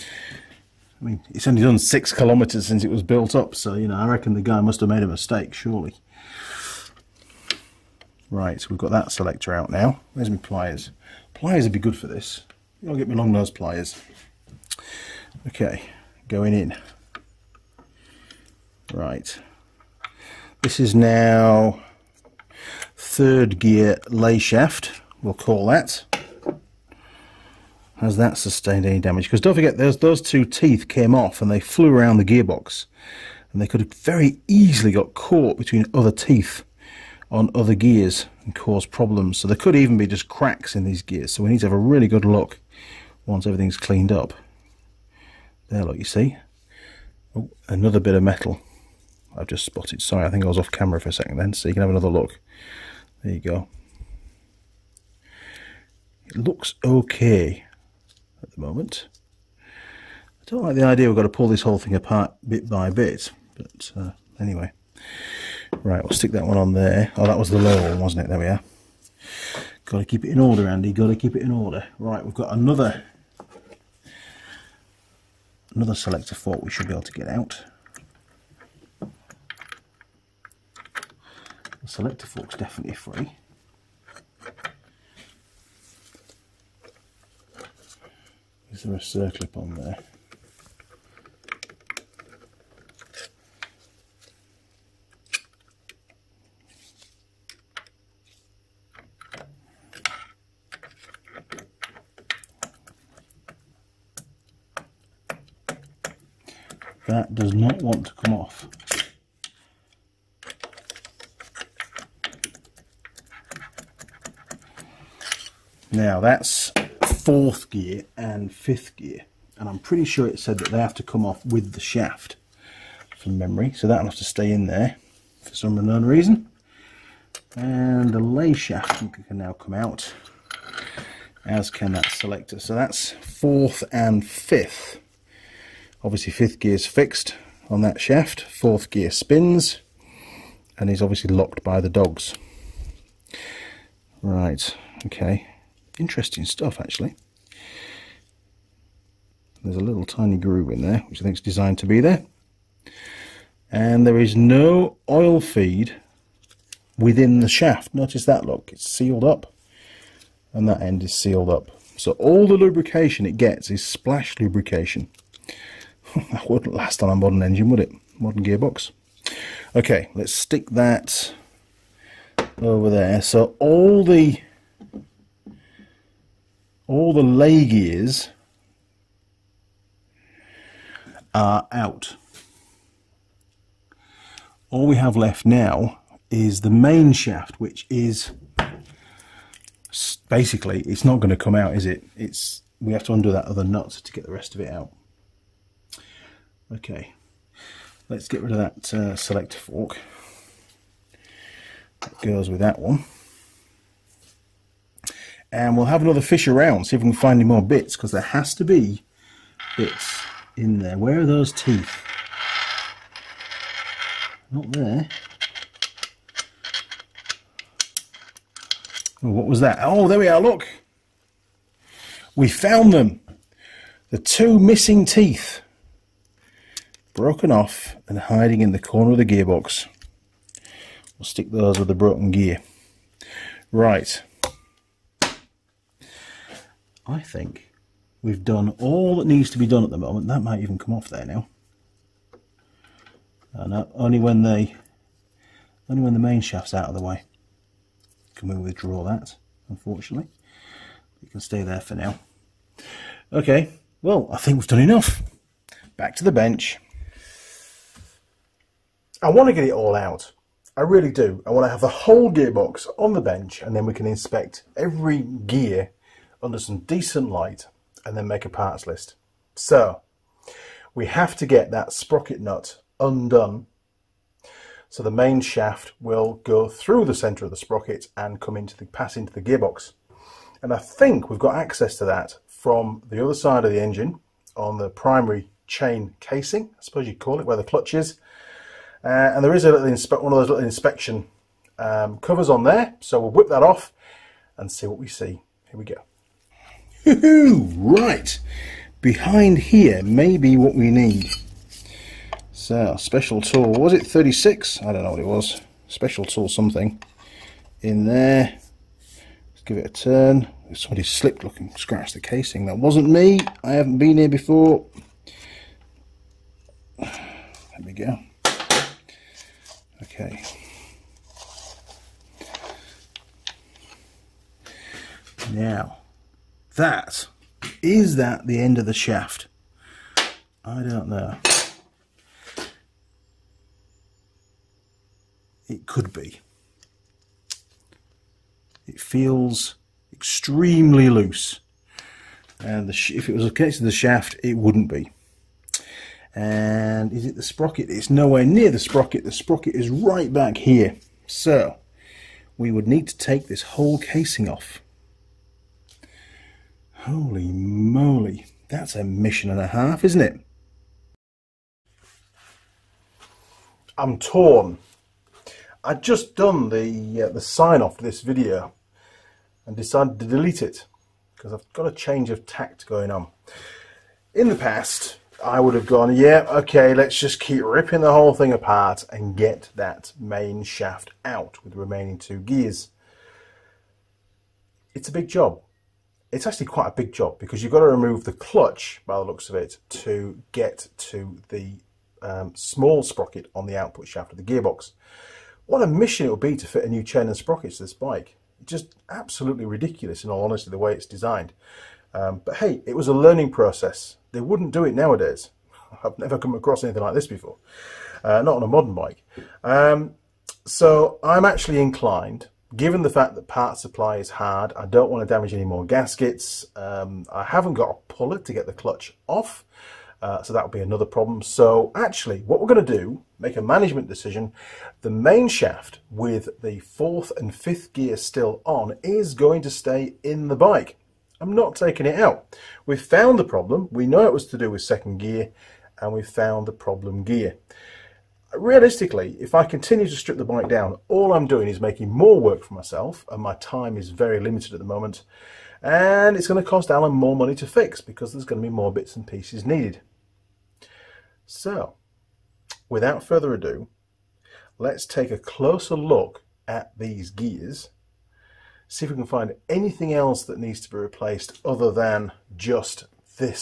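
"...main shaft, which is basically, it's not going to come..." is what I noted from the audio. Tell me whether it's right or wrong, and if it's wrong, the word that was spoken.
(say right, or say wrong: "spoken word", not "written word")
right.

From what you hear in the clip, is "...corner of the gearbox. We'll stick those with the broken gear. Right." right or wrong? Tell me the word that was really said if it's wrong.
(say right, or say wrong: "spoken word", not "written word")
right.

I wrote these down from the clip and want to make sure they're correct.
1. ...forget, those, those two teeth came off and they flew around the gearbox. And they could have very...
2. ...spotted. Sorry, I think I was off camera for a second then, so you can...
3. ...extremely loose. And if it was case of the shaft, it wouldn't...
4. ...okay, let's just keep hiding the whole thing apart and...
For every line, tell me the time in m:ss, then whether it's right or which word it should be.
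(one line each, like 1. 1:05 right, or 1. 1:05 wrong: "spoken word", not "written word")
1. 0:29 right
2. 0:49 right
3. 5:40 right
4. 6:16 wrong: "ripping", not "hiding".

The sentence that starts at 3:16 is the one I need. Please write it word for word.
Okay, let's get rid of that uh, selector fork.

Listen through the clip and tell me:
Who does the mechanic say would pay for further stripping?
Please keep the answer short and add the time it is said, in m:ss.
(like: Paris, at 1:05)
Alan, at 7:26.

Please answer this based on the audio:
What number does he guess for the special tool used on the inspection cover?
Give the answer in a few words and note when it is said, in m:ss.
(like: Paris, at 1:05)
36, at 5:04.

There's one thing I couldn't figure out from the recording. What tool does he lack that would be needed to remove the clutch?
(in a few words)
a puller.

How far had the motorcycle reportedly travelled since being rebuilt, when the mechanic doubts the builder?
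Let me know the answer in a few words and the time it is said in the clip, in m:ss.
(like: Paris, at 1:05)
6 kilometres, at 0:01.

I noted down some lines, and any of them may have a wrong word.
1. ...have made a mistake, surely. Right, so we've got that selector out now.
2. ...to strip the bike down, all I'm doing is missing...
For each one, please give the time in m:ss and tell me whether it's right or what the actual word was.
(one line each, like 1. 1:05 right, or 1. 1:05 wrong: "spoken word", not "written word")
1. 0:04 right
2. 7:20 wrong: "making", not "missing".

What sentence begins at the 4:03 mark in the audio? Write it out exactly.
And uh, only when the only when the main shaft's out of the way can we withdraw that.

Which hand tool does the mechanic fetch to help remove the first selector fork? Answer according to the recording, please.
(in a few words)
long nose pliers.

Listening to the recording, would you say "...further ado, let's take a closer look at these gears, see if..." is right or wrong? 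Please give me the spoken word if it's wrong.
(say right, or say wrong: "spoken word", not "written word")
right.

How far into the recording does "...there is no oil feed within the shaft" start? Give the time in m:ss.
2:34.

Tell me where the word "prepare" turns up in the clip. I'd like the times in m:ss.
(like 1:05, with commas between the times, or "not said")
not said.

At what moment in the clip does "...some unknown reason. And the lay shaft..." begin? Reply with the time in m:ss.
2:05.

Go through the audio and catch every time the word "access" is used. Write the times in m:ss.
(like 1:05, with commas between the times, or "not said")
4:41.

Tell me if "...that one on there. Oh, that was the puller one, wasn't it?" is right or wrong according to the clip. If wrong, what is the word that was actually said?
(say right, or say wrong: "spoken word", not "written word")
wrong: "lower", not "puller".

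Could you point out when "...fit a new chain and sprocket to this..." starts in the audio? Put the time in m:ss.
6:36.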